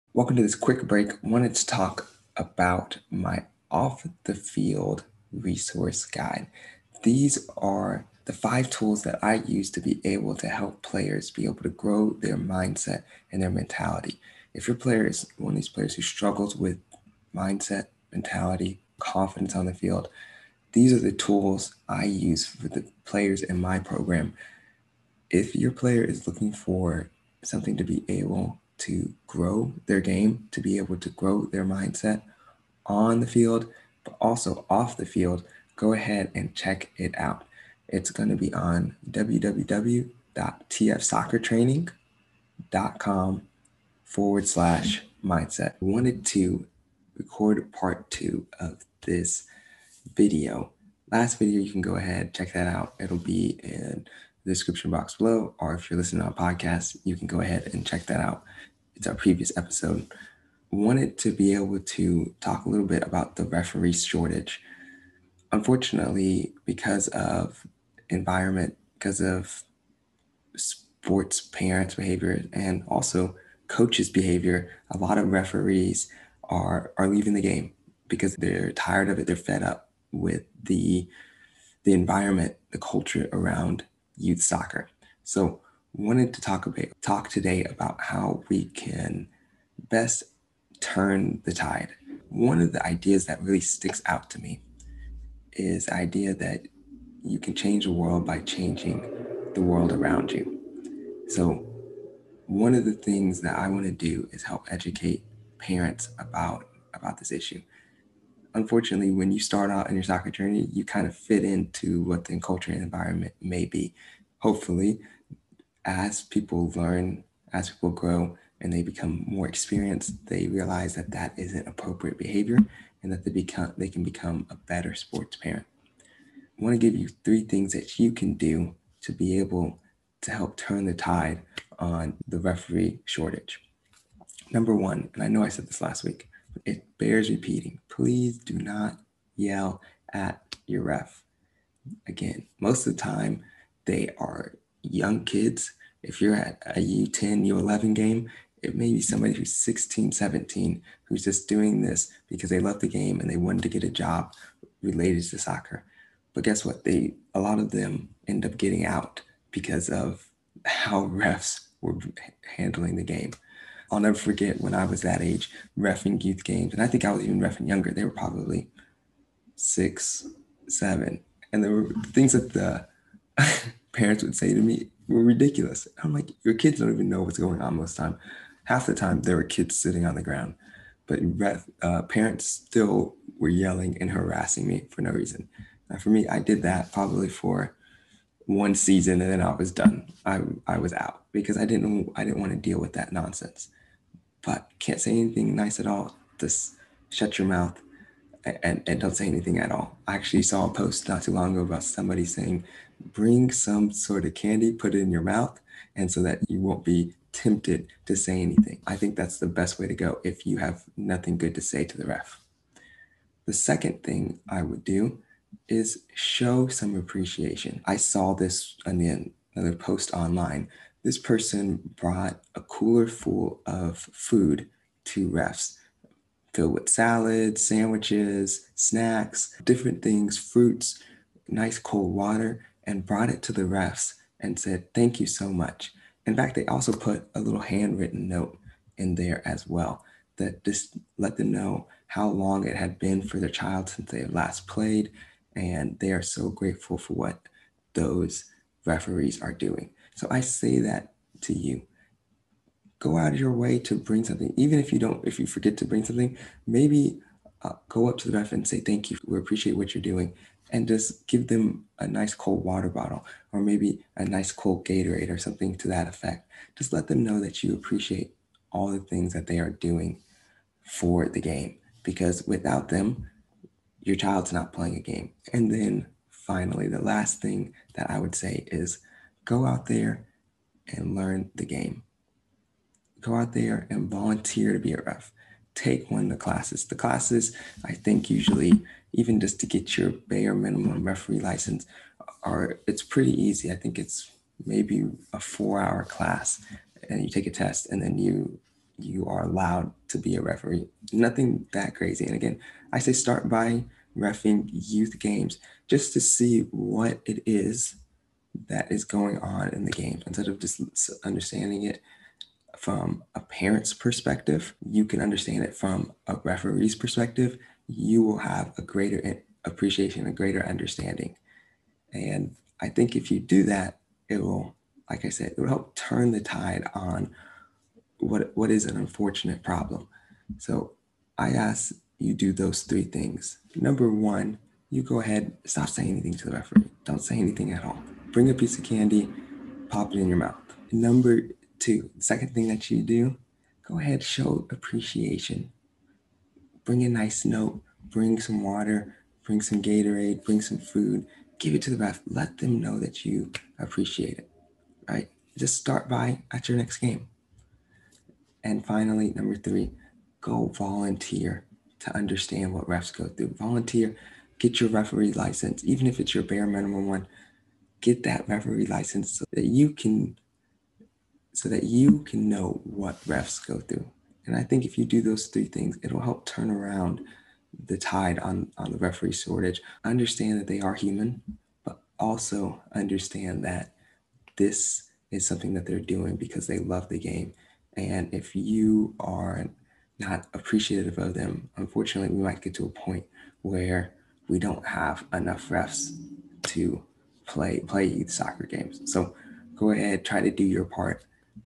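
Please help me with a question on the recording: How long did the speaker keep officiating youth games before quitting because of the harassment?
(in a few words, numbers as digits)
One season.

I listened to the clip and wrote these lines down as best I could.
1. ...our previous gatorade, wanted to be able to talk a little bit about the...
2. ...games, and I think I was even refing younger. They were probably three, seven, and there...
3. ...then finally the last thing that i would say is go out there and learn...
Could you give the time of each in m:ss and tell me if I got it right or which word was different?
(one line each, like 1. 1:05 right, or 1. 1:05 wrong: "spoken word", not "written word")
1. 0:59 wrong: "episode", not "gatorade"
2. 2:46 wrong: "six", not "three"
3. 4:35 right.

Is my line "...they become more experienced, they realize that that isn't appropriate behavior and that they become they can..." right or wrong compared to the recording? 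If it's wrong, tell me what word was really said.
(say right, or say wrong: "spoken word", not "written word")
right.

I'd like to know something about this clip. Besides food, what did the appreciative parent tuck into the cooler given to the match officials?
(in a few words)
Handwritten note.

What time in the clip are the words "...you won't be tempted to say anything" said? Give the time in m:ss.
3:26.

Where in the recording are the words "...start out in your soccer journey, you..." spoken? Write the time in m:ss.
1:49.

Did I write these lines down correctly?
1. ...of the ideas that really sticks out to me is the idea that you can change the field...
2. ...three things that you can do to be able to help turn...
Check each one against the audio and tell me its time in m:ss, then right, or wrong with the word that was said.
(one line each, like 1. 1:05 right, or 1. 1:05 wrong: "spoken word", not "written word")
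1. 1:32 wrong: "world", not "field"
2. 2:07 right.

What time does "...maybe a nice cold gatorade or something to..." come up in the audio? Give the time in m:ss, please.
4:23.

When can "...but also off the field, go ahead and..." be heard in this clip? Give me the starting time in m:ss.
0:34.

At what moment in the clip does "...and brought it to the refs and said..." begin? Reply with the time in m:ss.
3:52.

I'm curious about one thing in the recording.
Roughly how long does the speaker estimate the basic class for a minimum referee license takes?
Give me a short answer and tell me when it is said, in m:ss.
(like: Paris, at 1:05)
4 hours, at 4:55.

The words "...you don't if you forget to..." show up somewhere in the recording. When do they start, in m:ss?
4:14.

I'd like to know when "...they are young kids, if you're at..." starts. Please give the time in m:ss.
2:23.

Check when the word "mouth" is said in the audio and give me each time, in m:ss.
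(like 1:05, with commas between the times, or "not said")
3:17, 3:25, 5:40.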